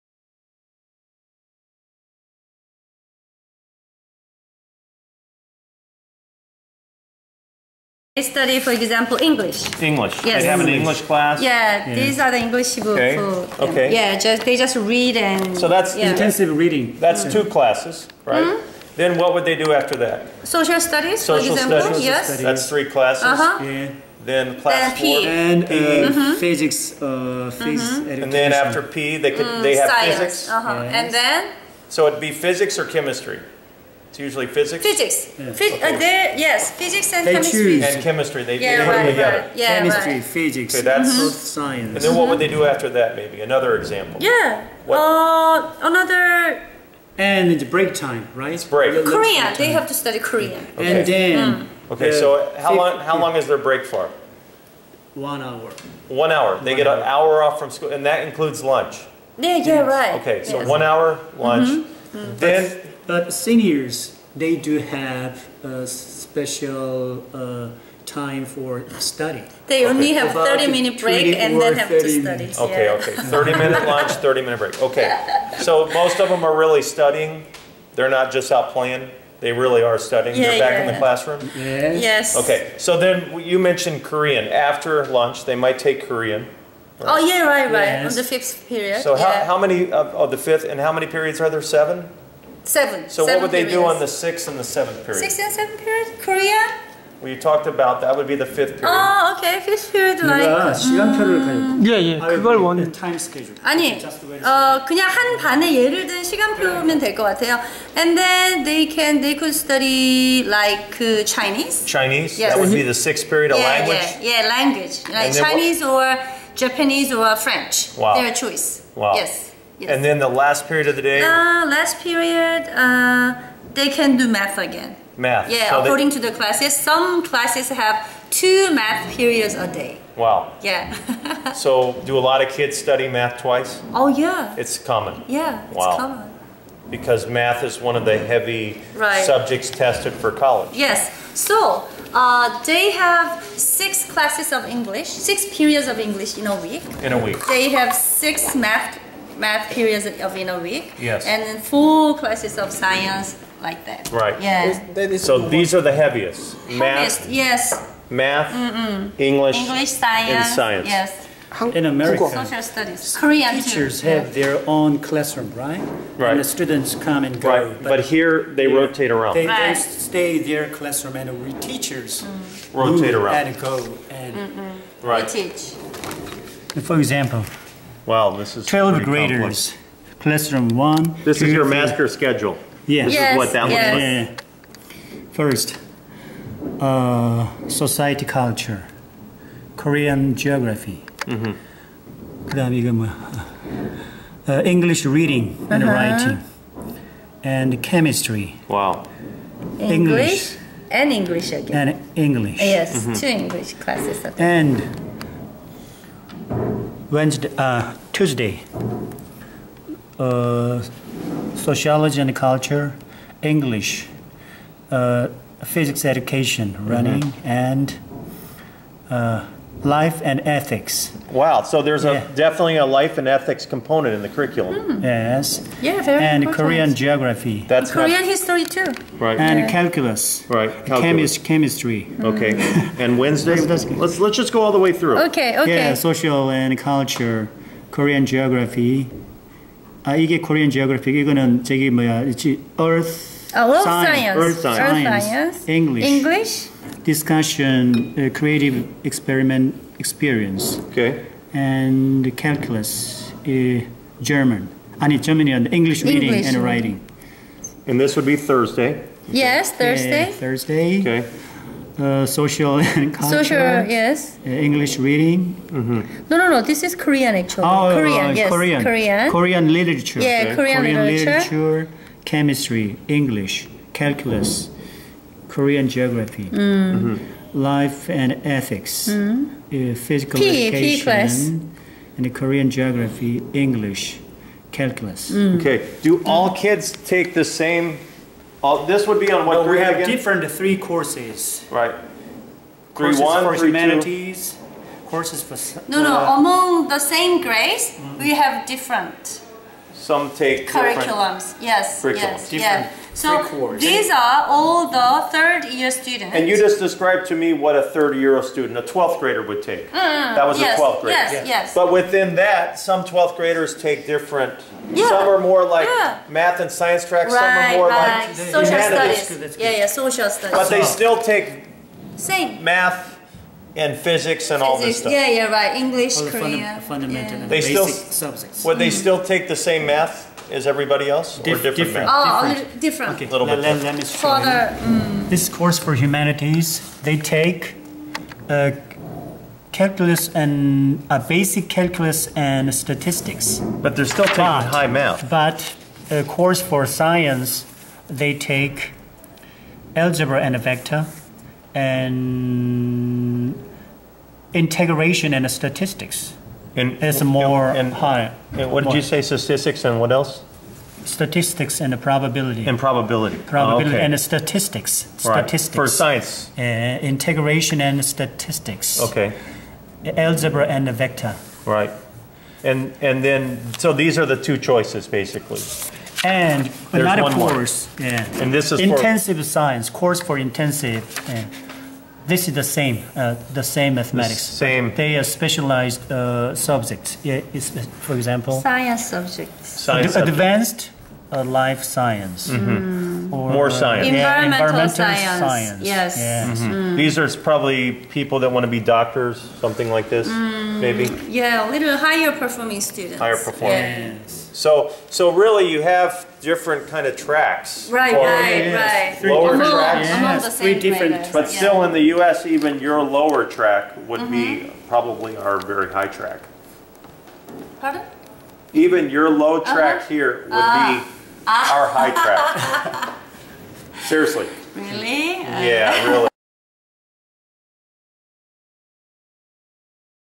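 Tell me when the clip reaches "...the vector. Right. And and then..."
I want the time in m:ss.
6:10.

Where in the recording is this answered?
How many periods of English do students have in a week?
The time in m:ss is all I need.
2:25.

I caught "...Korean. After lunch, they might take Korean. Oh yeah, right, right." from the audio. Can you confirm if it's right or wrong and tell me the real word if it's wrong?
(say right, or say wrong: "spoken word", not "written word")
right.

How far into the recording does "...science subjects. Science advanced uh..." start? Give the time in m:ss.
6:28.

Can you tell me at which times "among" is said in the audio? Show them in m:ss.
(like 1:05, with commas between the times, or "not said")
4:56, 6:49.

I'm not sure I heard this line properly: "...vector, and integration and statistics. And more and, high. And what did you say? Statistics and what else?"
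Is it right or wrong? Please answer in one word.
right.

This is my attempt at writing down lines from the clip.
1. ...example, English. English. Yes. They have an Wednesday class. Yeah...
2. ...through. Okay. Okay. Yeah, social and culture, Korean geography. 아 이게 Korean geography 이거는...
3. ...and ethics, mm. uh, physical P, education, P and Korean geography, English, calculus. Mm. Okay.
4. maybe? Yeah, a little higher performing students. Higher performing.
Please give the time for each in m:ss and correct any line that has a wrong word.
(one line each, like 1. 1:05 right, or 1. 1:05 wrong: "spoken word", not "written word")
1. 0:08 wrong: "English", not "Wednesday"
2. 3:54 right
3. 4:38 right
4. 6:40 right.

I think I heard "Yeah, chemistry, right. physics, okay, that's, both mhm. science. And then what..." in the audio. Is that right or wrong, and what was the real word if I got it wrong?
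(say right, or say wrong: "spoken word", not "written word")
right.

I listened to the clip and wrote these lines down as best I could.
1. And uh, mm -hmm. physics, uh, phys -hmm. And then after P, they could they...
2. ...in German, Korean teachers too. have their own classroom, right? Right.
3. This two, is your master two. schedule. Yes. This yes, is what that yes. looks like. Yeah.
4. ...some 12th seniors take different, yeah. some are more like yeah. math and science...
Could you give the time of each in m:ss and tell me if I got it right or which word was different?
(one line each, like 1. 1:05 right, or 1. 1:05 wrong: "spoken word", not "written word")
1. 0:25 right
2. 2:41 wrong: "America", not "German"
3. 3:01 wrong: "three", not "two"
4. 5:12 wrong: "graders", not "seniors".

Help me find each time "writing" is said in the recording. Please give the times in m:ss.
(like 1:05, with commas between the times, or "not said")
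3:15, 4:16.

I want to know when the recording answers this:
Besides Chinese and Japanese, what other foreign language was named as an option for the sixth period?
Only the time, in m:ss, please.
1:57.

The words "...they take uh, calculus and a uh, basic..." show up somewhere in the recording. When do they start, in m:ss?
5:37.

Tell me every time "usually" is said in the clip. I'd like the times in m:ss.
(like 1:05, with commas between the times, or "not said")
0:34.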